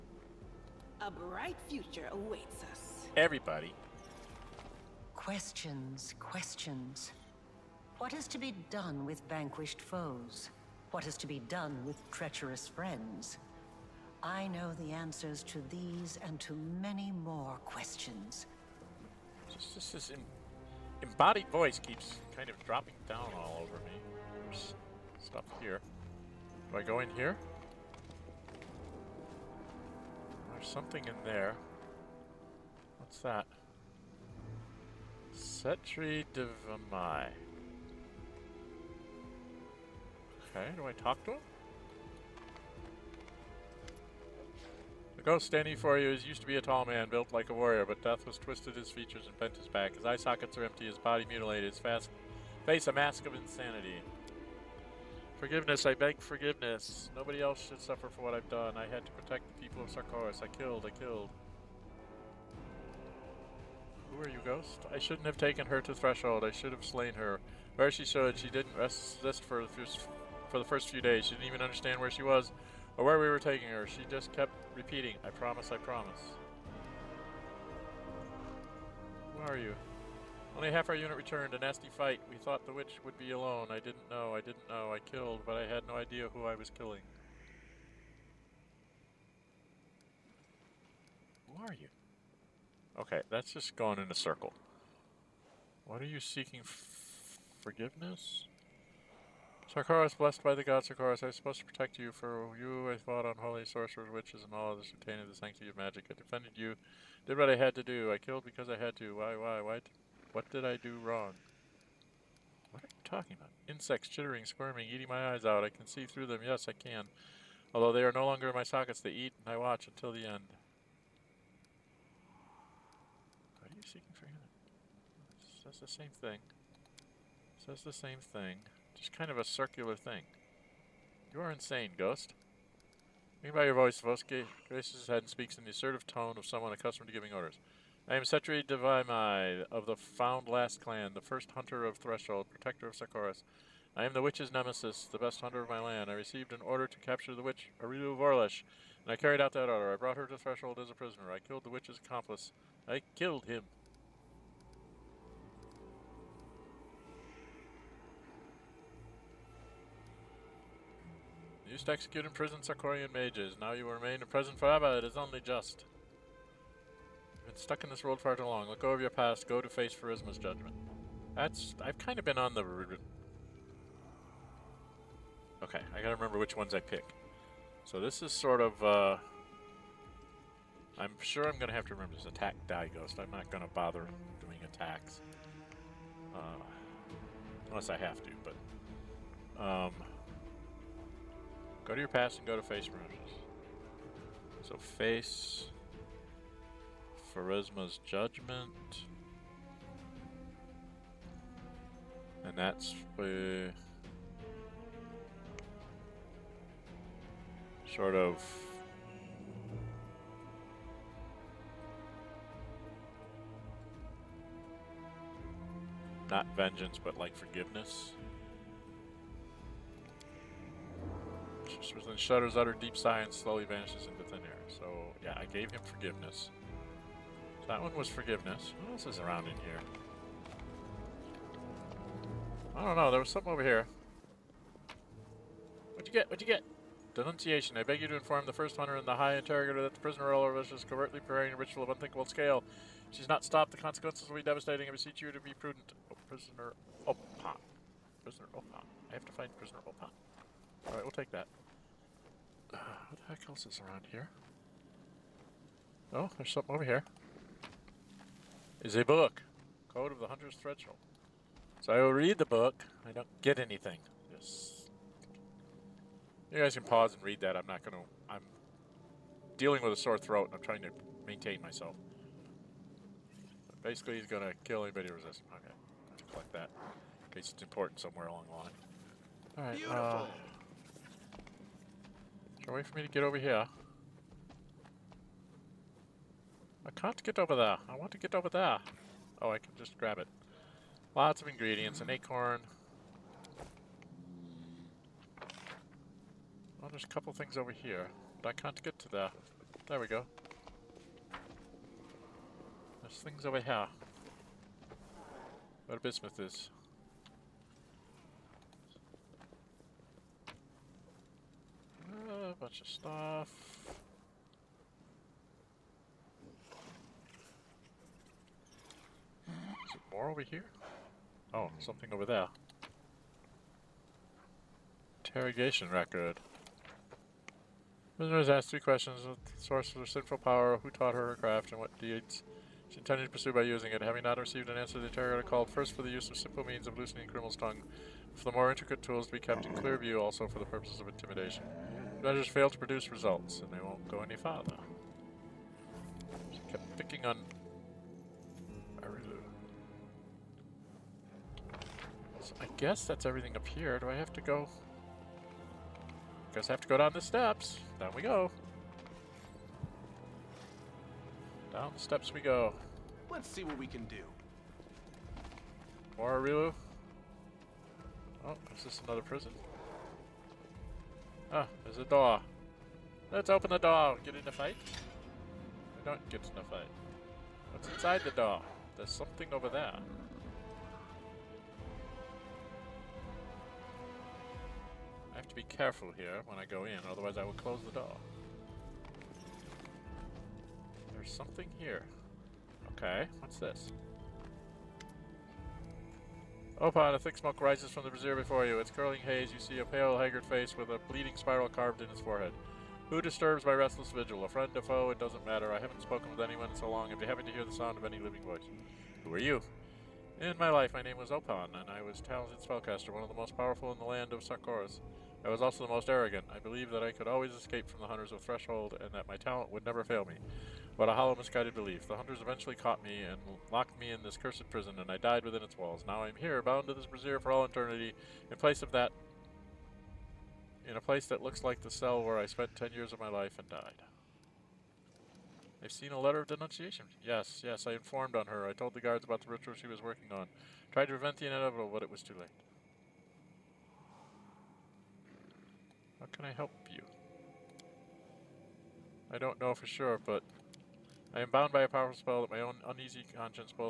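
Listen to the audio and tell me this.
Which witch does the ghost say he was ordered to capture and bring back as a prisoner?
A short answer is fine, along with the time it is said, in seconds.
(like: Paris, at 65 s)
Areelu Vorlesh, at 147 s.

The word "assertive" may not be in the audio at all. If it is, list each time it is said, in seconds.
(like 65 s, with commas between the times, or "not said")
135 s.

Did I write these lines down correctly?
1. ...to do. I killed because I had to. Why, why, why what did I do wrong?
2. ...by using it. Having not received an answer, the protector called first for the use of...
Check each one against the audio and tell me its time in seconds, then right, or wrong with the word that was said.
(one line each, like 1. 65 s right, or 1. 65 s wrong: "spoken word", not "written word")
1. 107 s right
2. 333 s wrong: "interrogator", not "protector".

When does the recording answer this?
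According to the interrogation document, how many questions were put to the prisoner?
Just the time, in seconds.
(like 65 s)
328 s.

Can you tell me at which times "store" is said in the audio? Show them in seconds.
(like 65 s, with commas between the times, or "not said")
not said.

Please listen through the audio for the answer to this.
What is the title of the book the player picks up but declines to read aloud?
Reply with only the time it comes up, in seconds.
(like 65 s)
259 s.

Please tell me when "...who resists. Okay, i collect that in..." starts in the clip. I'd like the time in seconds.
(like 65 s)
275 s.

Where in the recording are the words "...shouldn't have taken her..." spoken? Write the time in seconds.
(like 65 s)
64 s.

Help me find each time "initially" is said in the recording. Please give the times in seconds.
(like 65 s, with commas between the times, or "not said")
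not said.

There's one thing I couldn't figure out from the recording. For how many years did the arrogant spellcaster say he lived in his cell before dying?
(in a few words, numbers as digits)
10.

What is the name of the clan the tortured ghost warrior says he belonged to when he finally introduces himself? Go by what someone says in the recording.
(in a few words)
Found Last clan.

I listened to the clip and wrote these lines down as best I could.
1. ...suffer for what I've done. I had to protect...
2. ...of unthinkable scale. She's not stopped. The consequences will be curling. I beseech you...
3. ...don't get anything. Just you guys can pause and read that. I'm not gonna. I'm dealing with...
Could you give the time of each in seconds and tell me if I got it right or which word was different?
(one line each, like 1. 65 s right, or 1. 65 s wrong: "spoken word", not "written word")
1. 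57 s right
2. 241 s wrong: "devastating", not "curling"
3. 263 s right.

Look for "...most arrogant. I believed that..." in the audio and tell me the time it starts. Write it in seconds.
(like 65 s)
415 s.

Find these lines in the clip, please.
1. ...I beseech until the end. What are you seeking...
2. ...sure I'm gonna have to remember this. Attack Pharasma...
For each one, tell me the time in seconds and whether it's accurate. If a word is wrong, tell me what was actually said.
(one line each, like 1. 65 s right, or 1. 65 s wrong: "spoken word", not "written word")
1. 119 s wrong: "watch", not "beseech"
2. 181 s wrong: "Die", not "Pharasma".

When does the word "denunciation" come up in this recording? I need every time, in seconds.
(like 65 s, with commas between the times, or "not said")
237 s, 436 s.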